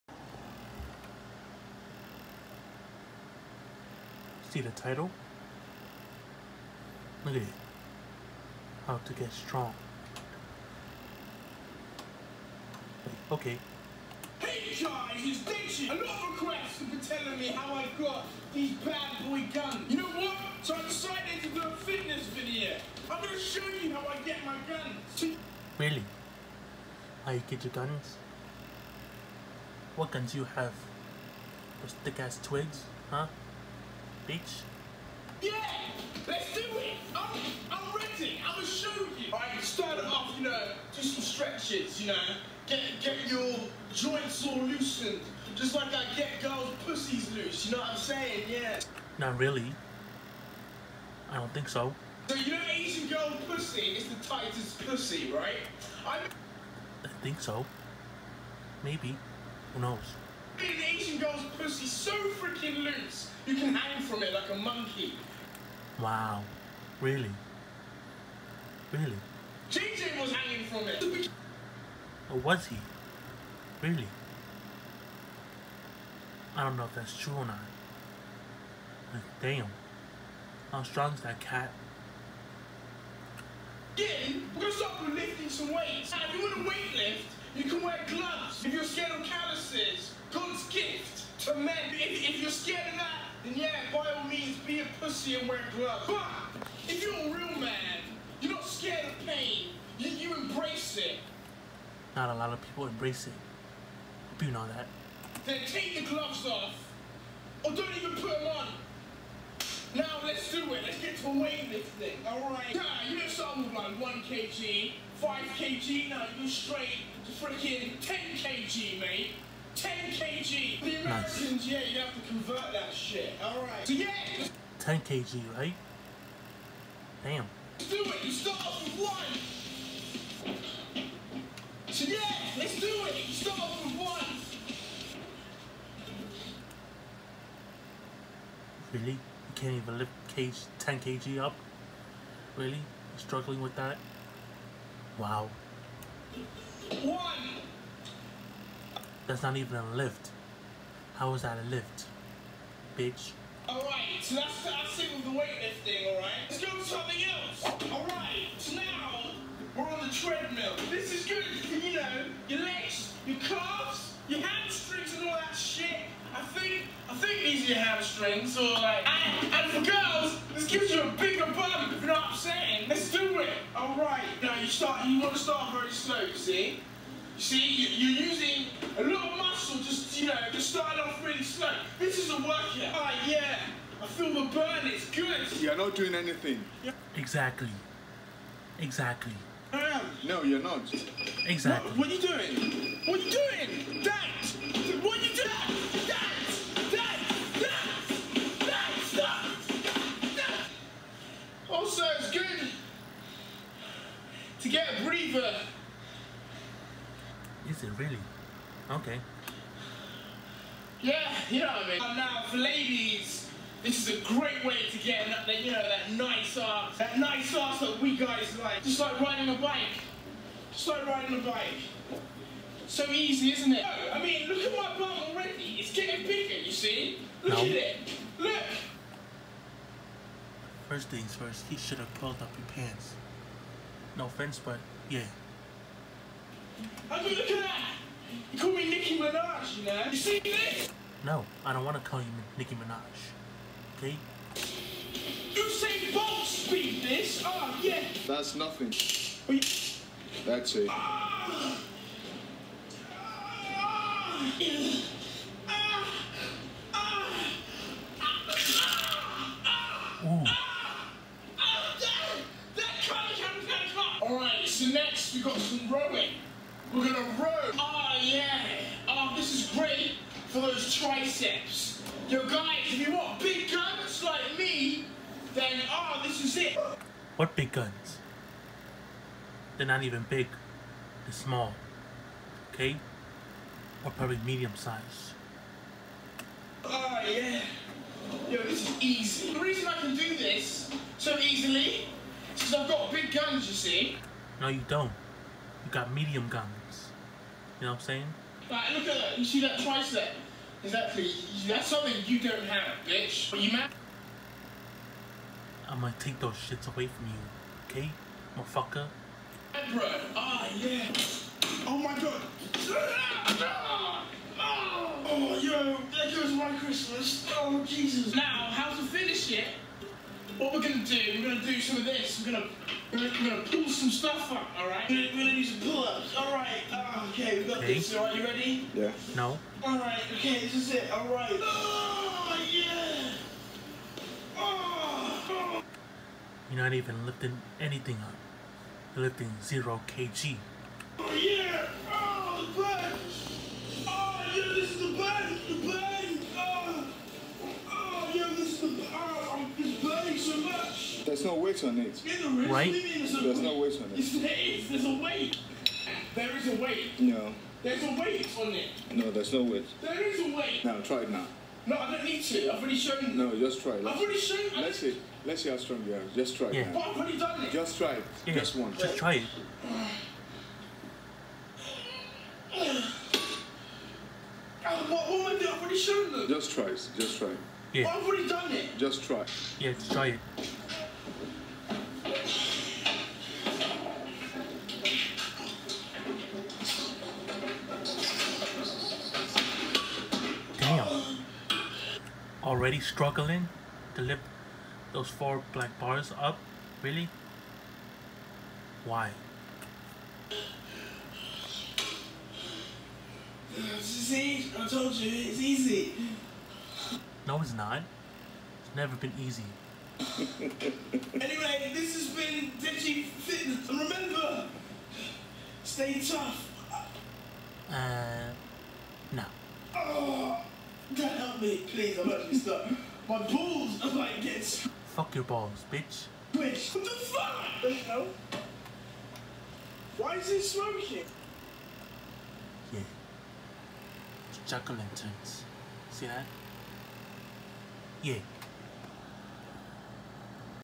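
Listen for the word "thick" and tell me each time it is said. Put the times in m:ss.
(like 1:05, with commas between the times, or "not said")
0:32.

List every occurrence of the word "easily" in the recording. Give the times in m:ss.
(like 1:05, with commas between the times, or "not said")
4:51.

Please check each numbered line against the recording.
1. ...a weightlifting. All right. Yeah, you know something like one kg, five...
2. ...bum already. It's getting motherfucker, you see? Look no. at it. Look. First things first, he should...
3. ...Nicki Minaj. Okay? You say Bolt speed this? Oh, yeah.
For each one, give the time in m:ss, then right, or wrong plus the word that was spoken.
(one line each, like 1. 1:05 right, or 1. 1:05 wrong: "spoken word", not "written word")
1. 1:51 right
2. 3:44 wrong: "bigger", not "motherfucker"
3. 4:02 right.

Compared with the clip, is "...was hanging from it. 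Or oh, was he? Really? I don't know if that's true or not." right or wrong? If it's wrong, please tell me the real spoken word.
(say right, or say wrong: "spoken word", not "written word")
right.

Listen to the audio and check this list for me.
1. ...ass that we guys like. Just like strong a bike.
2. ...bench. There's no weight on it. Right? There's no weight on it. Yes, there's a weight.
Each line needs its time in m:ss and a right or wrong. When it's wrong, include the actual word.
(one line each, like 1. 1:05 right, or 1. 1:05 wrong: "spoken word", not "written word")
1. 3:37 wrong: "riding", not "strong"
2. 5:45 right.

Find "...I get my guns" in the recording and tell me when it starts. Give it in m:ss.
0:24.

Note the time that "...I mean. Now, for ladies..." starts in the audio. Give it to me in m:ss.
3:31.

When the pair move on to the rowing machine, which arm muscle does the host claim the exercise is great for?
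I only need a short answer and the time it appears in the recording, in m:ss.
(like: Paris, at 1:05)
triceps, at 4:30.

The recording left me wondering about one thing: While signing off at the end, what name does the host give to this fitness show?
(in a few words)
Ditchy Fitness.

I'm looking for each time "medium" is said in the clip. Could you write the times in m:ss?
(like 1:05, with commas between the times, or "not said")
4:44, 4:56.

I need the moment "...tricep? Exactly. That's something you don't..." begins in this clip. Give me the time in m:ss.
4:59.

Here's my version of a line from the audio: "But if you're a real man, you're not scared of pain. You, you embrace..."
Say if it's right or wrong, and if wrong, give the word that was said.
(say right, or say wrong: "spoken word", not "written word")
right.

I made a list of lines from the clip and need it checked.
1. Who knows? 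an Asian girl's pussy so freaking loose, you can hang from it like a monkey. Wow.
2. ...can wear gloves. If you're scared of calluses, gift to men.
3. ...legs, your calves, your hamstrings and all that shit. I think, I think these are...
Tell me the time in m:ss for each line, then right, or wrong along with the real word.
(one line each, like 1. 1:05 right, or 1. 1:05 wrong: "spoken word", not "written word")
1. 0:59 right
2. 1:27 right
3. 2:42 right.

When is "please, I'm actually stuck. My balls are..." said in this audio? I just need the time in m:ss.
7:02.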